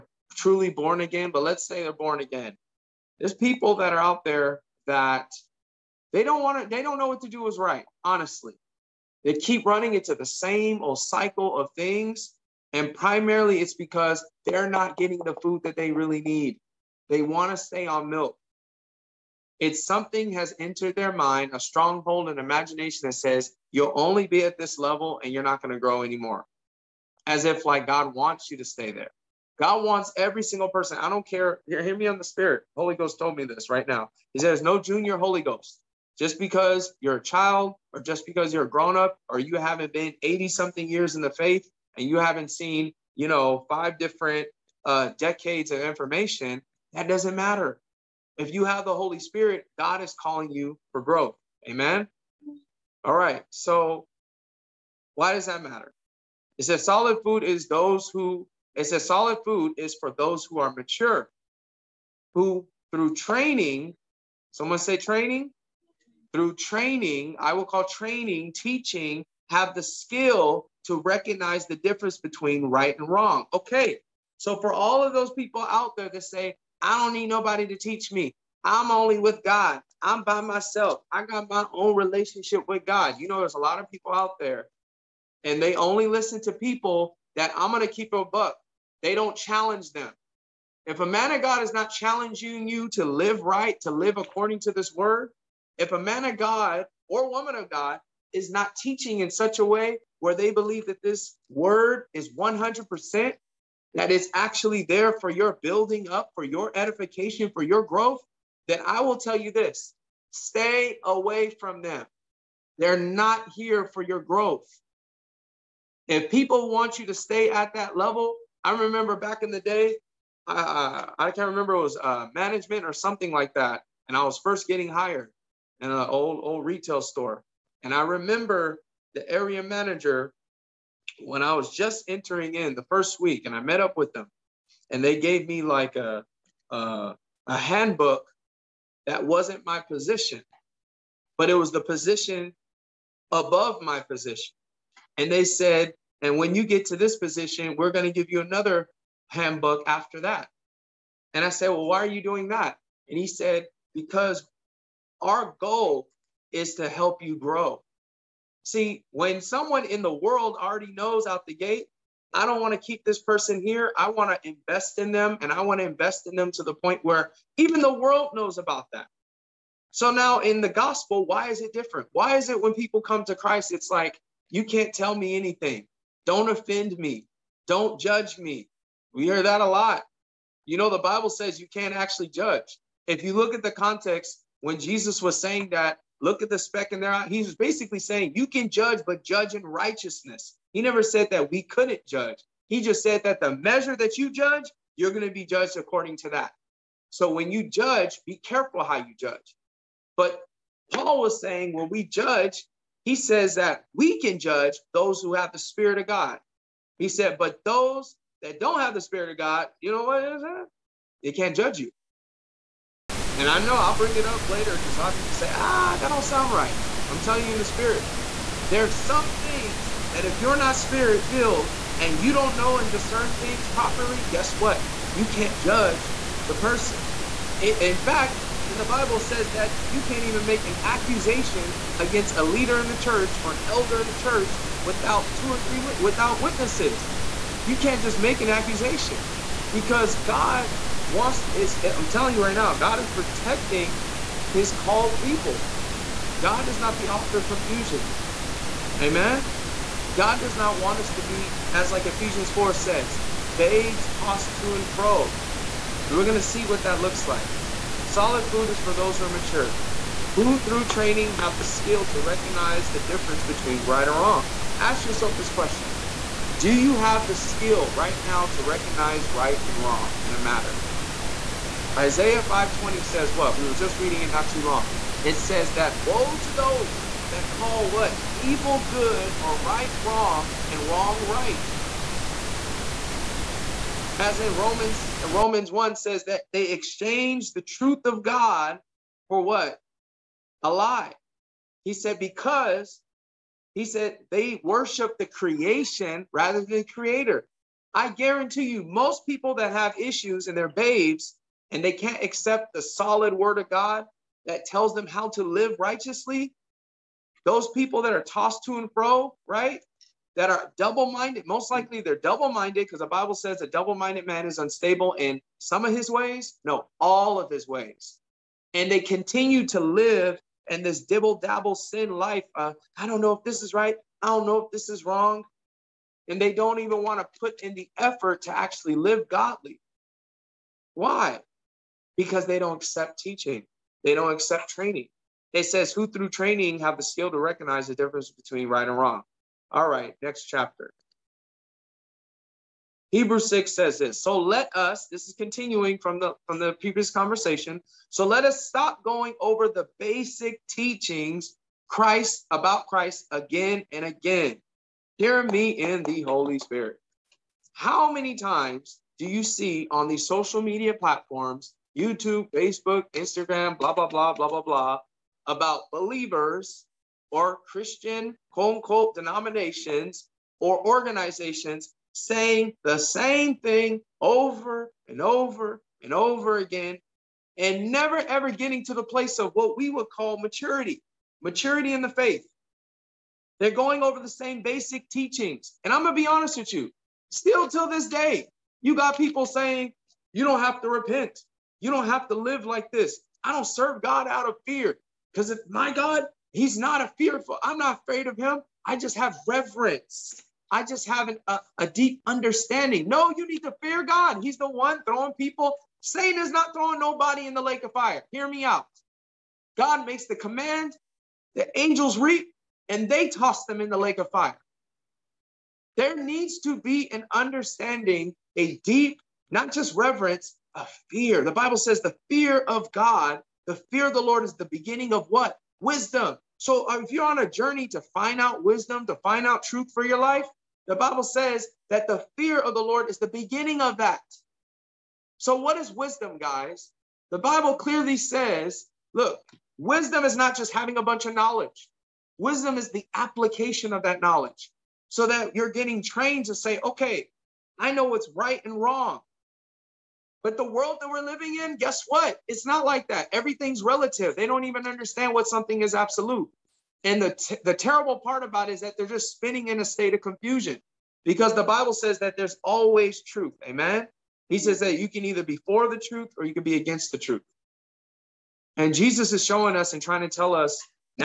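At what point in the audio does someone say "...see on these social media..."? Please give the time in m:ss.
5:59.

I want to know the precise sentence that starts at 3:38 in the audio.
There's some things that if you're not Spirit filled and you don't know and discern things properly, guess what?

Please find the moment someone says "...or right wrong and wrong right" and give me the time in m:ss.
4:39.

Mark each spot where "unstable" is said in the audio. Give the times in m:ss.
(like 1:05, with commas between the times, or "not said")
5:14.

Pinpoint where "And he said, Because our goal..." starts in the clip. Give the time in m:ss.
2:33.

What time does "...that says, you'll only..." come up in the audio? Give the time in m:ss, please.
0:23.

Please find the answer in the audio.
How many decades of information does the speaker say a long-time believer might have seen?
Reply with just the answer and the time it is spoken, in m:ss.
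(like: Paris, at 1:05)
5, at 0:43.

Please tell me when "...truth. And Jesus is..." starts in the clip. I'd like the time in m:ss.
7:47.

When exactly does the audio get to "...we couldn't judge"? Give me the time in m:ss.
3:11.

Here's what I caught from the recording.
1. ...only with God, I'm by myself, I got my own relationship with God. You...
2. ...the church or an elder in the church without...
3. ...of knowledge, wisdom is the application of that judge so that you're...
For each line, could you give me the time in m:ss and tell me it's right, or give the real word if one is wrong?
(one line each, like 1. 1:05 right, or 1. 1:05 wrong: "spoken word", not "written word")
1. 1:18 right
2. 3:52 right
3. 7:21 wrong: "knowledge", not "judge".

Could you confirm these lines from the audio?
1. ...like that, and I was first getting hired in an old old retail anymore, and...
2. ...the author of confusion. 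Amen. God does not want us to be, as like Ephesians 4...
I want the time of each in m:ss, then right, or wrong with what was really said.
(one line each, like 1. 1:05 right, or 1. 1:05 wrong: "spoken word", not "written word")
1. 2:03 wrong: "store", not "anymore"
2. 4:06 right.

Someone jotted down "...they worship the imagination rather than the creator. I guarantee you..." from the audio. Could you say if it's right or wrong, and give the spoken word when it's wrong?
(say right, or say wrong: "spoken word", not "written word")
wrong: "creation", not "imagination".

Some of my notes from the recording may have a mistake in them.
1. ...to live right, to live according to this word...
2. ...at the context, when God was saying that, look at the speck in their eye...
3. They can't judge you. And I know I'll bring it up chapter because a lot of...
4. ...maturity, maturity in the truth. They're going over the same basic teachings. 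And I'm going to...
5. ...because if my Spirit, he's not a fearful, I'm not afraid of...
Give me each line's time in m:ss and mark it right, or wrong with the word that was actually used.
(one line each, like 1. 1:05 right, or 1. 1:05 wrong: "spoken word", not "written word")
1. 1:32 right
2. 3:03 wrong: "Jesus", not "God"
3. 3:31 wrong: "later", not "chapter"
4. 6:20 wrong: "faith", not "truth"
5. 6:35 wrong: "God", not "Spirit".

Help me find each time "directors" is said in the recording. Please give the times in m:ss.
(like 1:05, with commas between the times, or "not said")
not said.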